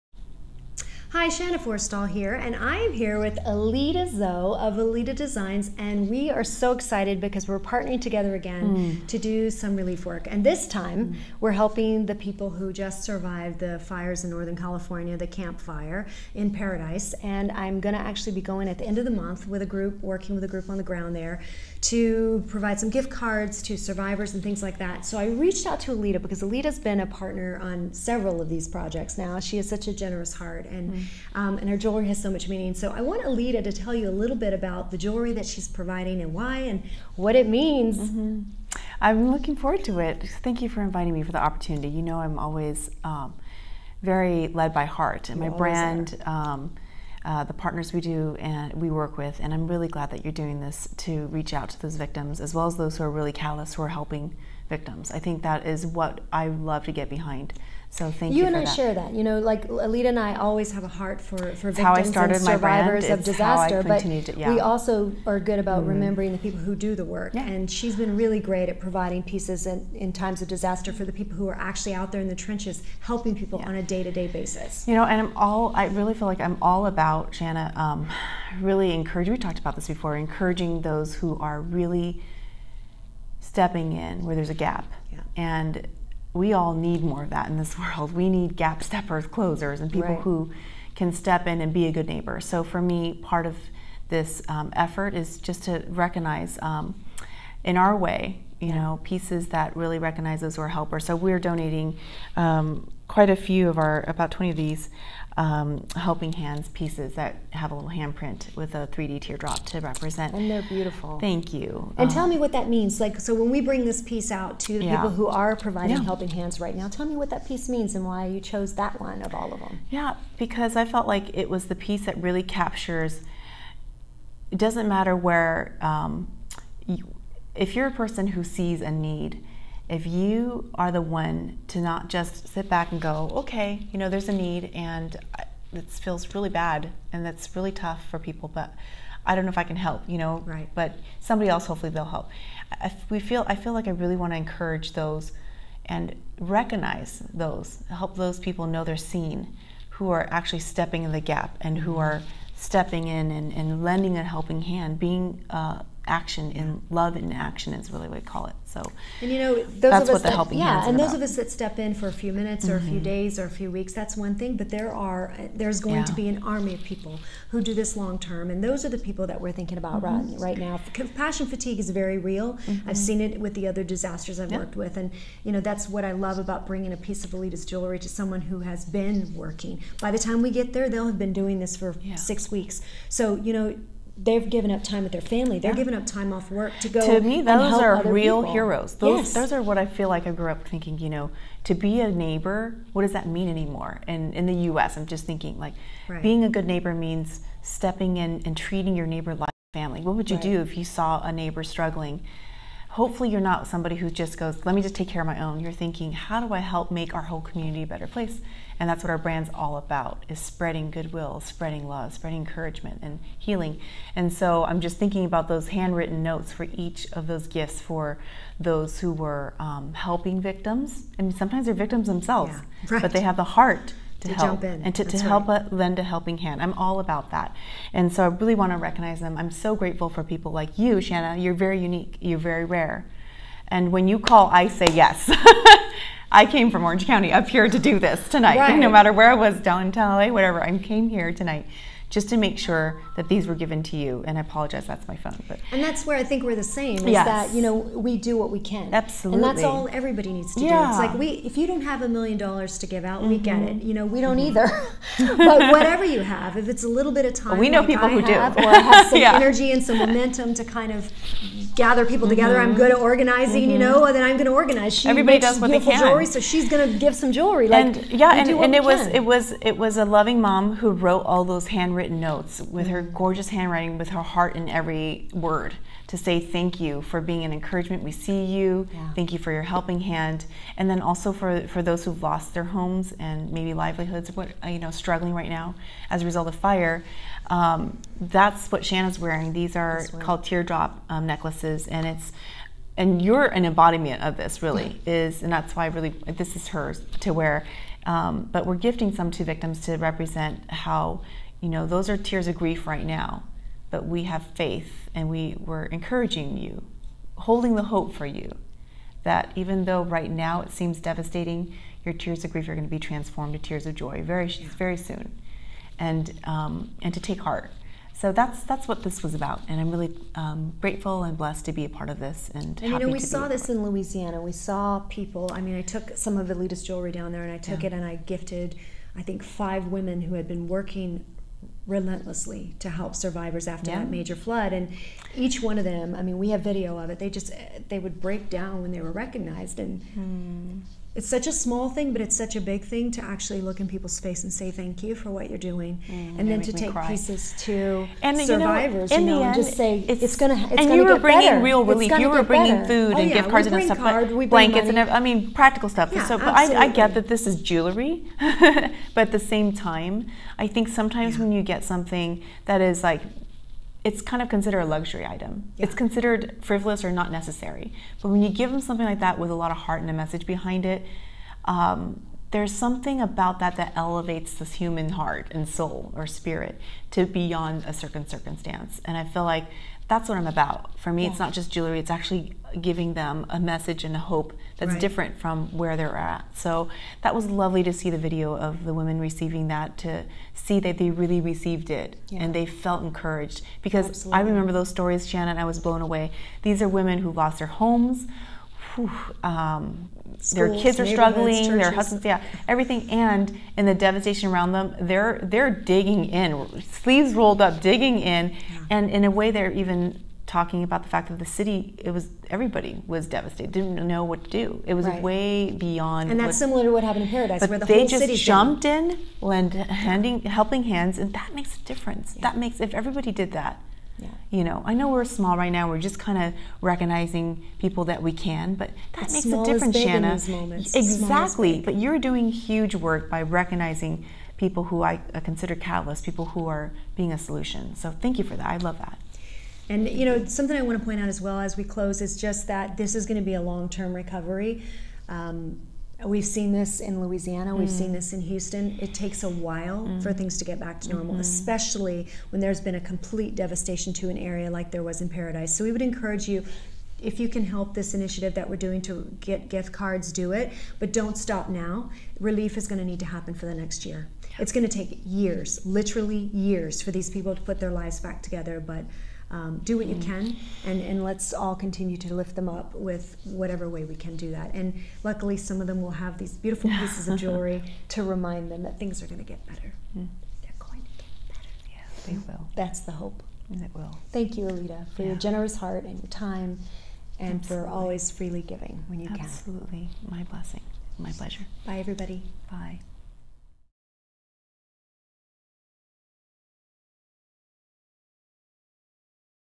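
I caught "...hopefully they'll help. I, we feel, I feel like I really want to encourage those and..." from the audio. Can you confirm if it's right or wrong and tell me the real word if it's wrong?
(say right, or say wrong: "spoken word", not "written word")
right.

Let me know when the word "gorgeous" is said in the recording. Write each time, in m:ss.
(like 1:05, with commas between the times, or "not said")
4:33.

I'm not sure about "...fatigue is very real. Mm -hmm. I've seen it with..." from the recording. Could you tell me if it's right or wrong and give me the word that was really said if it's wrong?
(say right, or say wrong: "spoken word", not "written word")
right.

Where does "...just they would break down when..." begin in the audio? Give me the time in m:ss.
5:37.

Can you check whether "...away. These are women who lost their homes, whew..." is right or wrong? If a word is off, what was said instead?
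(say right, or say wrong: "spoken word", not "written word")
right.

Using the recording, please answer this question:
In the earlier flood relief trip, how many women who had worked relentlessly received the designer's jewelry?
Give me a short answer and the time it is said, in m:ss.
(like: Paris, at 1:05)
five, at 5:29.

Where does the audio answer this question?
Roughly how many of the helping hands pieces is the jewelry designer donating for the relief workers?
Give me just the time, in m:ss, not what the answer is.
1:44.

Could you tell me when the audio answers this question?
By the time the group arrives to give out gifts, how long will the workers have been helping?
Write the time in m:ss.
3:02.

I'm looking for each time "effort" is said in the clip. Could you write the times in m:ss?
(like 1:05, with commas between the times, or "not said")
1:34.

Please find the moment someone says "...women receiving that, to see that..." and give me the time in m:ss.
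6:28.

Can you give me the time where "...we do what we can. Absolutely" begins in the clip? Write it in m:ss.
4:07.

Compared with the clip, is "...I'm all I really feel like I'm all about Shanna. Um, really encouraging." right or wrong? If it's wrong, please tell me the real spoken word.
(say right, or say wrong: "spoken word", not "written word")
right.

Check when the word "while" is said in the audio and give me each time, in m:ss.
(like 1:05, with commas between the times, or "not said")
7:29.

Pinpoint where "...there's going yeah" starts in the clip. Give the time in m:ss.
2:45.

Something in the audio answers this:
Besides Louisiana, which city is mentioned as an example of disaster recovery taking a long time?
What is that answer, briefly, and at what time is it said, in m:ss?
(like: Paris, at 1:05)
Houston, at 7:28.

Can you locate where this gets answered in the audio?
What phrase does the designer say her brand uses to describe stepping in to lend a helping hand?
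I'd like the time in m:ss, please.
2:36.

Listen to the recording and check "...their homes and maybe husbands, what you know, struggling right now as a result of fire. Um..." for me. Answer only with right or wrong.
wrong.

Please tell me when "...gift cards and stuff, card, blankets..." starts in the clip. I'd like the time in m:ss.
5:53.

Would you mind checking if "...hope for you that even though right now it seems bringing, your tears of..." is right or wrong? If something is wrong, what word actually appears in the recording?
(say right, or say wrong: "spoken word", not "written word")
wrong: "devastating", not "bringing".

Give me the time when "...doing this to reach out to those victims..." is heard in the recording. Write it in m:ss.
0:50.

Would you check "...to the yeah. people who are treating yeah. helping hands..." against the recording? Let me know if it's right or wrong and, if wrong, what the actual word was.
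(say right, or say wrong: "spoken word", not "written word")
wrong: "providing", not "treating".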